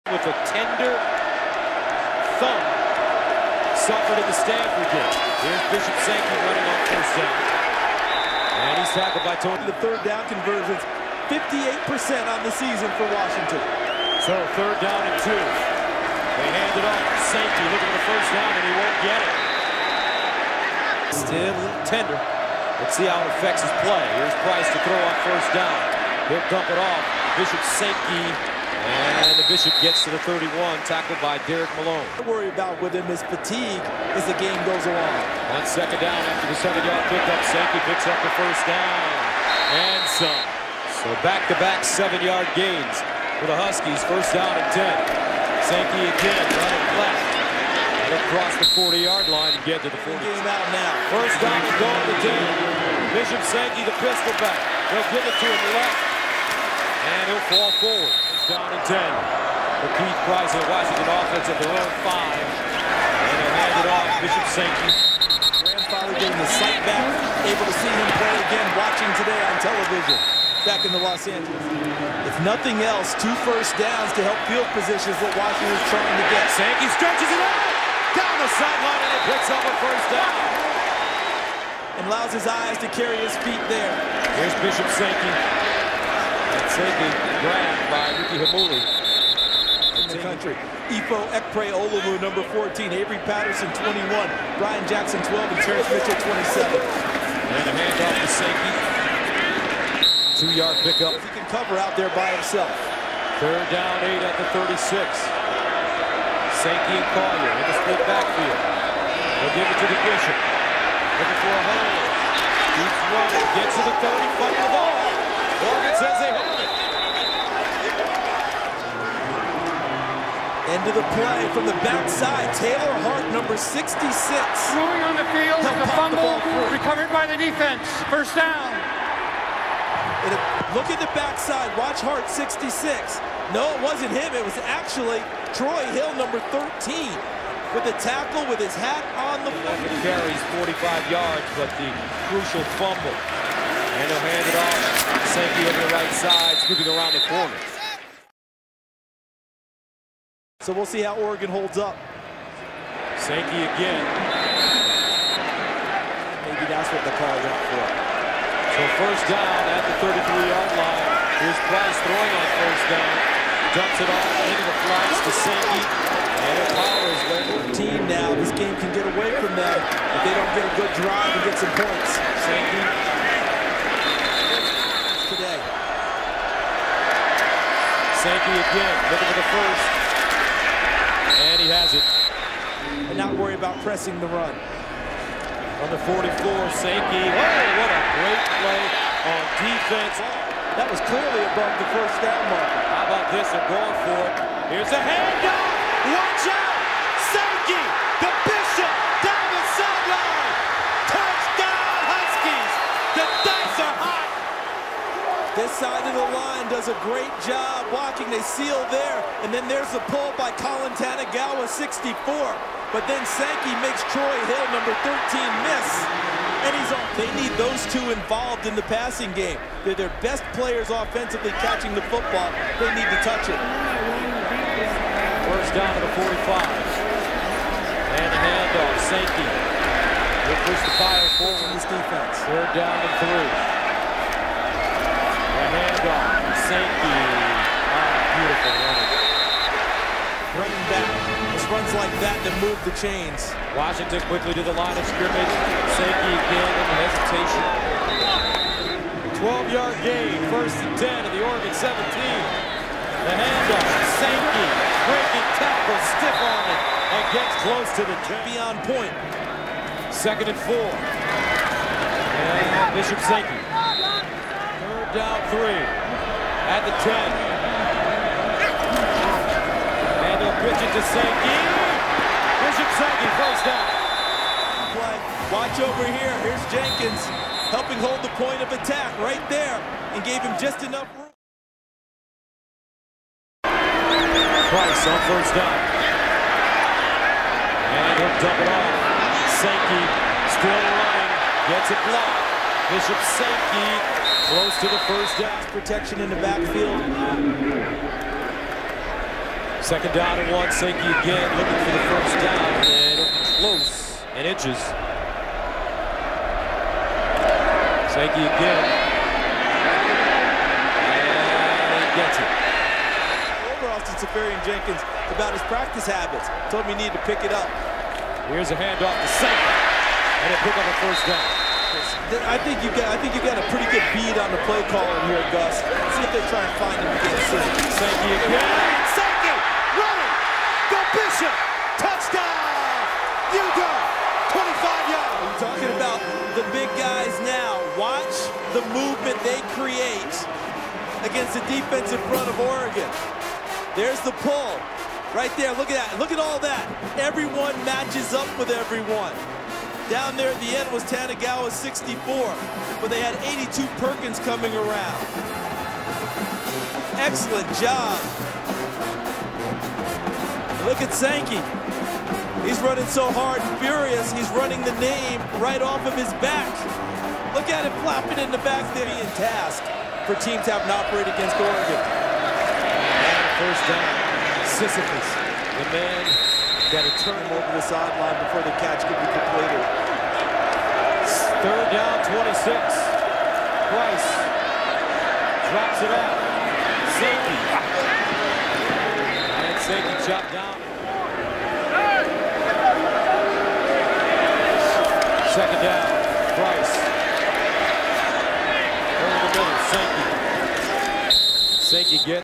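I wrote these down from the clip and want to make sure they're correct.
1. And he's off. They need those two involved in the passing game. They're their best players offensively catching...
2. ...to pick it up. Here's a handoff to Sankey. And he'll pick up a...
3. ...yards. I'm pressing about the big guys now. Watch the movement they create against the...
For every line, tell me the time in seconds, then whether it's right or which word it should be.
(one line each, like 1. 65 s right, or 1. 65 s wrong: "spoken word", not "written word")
1. 216 s right
2. 317 s right
3. 335 s wrong: "talking", not "pressing".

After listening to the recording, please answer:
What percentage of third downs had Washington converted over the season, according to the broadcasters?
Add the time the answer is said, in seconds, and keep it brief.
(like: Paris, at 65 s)
58%, at 11 s.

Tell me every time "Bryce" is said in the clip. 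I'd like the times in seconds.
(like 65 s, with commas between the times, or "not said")
382 s, 396 s.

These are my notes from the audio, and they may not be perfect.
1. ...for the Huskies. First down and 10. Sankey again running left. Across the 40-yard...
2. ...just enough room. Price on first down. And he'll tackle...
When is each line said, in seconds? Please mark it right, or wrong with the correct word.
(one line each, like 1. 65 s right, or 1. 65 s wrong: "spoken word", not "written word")
1. 43 s right
2. 280 s wrong: "double", not "tackle".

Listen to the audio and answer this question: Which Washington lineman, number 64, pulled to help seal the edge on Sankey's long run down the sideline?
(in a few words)
Colin Tanigawa.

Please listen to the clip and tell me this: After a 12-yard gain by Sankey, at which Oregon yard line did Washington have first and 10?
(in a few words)
17.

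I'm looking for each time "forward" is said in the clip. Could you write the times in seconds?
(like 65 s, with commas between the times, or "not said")
57 s, 231 s.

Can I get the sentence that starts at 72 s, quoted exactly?
If nothing else, two first downs to help field positions what Washington's trying to get.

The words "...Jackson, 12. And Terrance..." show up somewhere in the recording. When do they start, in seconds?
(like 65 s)
94 s.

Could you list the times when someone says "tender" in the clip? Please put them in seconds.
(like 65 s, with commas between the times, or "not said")
0 s, 21 s.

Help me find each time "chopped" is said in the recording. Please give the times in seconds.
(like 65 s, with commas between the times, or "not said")
390 s.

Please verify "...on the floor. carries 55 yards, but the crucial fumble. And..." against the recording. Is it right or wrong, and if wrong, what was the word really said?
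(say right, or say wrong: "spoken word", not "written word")
wrong: "45", not "55".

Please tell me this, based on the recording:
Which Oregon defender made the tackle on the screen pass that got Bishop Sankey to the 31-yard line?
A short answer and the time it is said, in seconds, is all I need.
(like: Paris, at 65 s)
Derrick Malone, at 31 s.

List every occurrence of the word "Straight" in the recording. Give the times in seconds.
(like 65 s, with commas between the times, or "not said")
290 s.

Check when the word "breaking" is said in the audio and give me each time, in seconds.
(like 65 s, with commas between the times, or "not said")
255 s.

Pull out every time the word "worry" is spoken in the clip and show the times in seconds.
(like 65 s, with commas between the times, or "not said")
32 s, 183 s.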